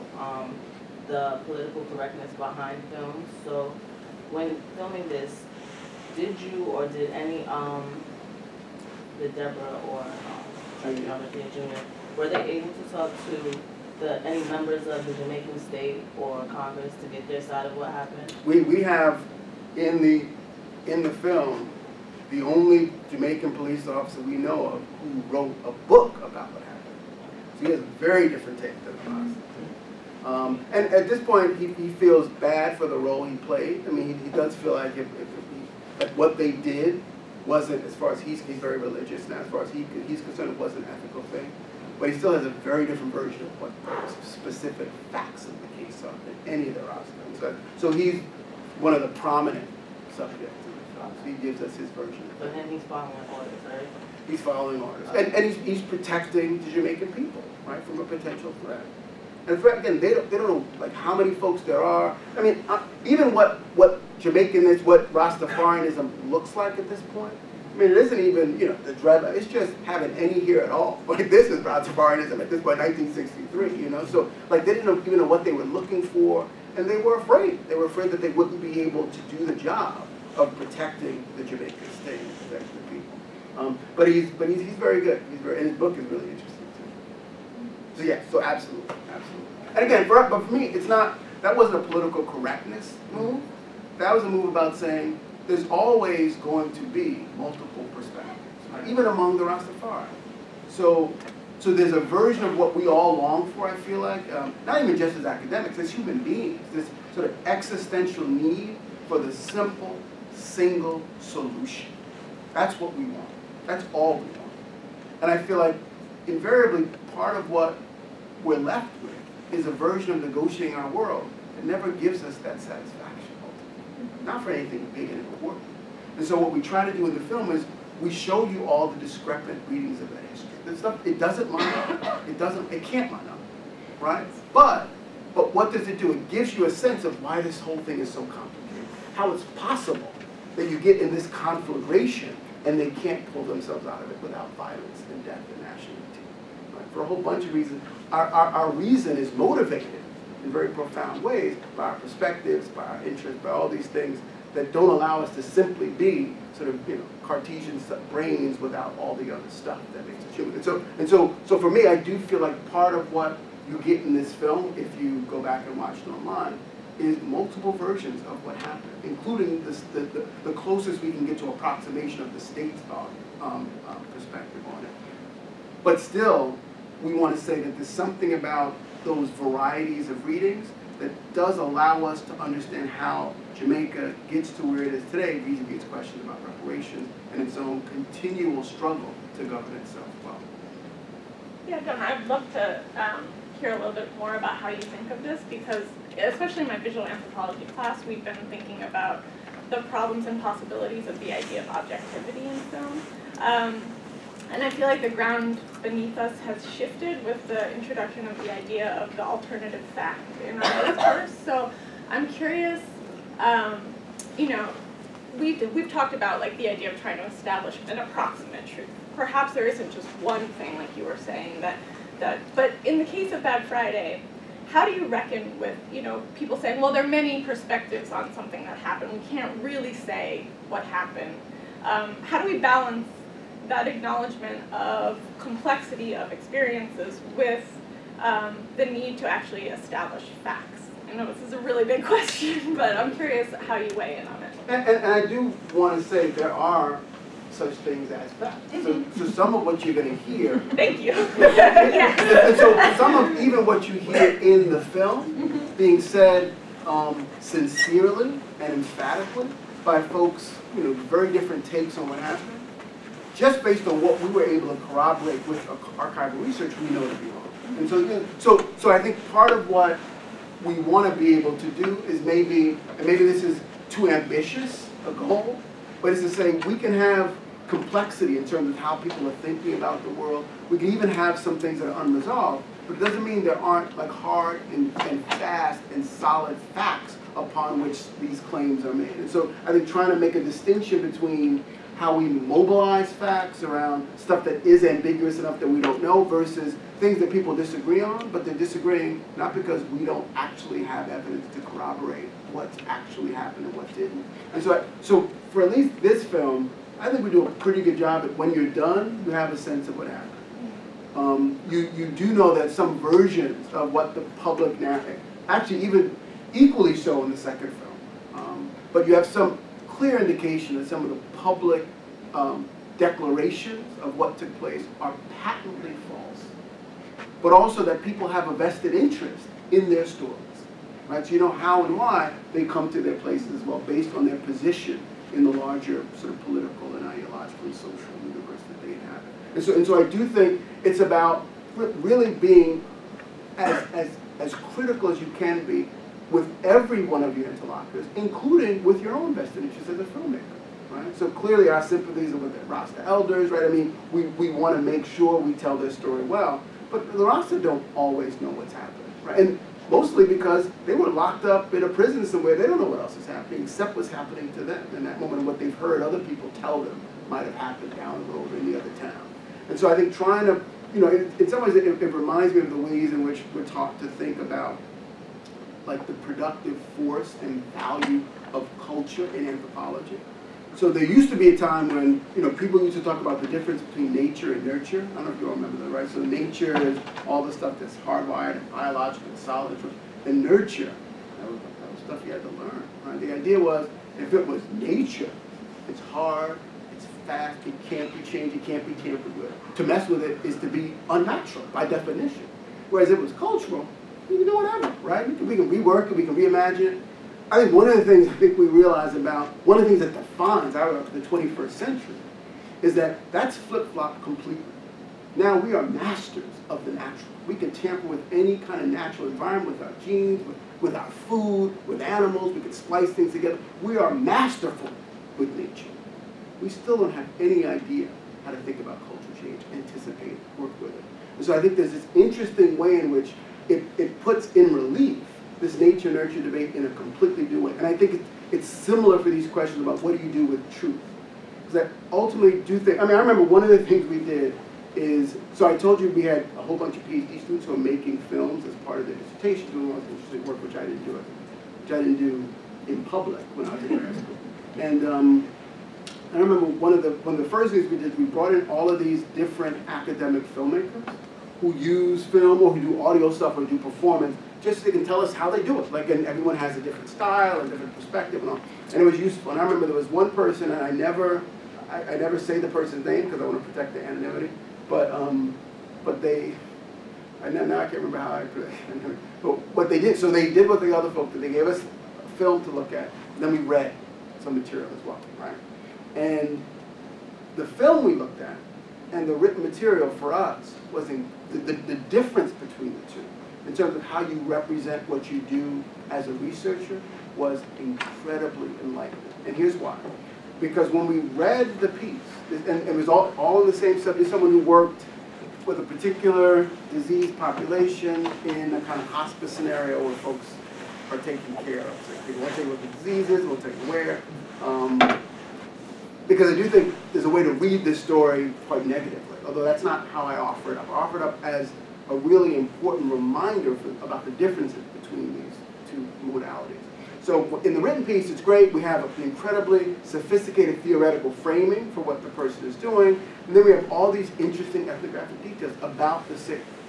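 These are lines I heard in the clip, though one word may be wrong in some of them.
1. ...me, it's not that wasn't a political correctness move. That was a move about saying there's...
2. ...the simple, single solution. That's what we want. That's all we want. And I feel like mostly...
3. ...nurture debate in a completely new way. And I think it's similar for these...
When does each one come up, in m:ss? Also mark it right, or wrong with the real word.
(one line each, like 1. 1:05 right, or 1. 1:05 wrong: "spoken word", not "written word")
1. 1:30 right
2. 1:49 wrong: "invariably", not "mostly"
3. 7:16 right.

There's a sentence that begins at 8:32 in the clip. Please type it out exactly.
So people will tell you what the disease is, we'll tell you where.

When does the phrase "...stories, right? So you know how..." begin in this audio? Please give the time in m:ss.
5:30.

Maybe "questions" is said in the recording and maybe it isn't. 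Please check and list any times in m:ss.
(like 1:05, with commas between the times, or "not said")
3:05, 4:02, 7:19.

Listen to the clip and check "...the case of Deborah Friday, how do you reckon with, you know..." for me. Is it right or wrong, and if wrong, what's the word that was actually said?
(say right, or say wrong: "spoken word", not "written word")
wrong: "Bad", not "Deborah".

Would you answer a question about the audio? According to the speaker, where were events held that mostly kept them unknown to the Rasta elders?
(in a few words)
in a prison.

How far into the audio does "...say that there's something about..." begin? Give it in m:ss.
2:57.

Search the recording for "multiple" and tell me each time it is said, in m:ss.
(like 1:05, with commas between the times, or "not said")
1:37, 2:47.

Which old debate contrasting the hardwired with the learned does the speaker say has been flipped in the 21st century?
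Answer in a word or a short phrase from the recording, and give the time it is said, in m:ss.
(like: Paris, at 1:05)
nature and nurture, at 6:24.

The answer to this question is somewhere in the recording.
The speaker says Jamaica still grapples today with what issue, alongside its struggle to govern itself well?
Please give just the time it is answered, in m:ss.
3:06.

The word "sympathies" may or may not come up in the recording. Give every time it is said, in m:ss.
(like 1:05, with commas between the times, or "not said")
5:51.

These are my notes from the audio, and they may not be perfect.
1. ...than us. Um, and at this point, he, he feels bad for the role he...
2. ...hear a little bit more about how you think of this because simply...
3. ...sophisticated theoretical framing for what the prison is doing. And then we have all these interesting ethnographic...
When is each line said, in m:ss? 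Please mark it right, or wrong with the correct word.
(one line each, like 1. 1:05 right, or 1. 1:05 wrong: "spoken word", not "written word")
1. 0:28 right
2. 3:13 wrong: "especially", not "simply"
3. 8:50 wrong: "person", not "prison".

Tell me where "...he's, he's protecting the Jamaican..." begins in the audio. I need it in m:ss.
0:55.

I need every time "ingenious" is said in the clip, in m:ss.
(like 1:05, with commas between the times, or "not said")
not said.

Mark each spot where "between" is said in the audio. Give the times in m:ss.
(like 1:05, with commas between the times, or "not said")
4:51, 6:23, 8:12, 8:45.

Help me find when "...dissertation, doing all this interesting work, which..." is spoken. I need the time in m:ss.
7:29.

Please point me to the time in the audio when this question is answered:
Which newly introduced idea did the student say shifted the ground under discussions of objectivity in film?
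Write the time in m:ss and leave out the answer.
3:29.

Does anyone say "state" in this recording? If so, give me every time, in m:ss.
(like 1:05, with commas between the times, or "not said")
0:15, 1:22, 2:52.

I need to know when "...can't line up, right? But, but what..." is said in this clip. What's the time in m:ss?
2:12.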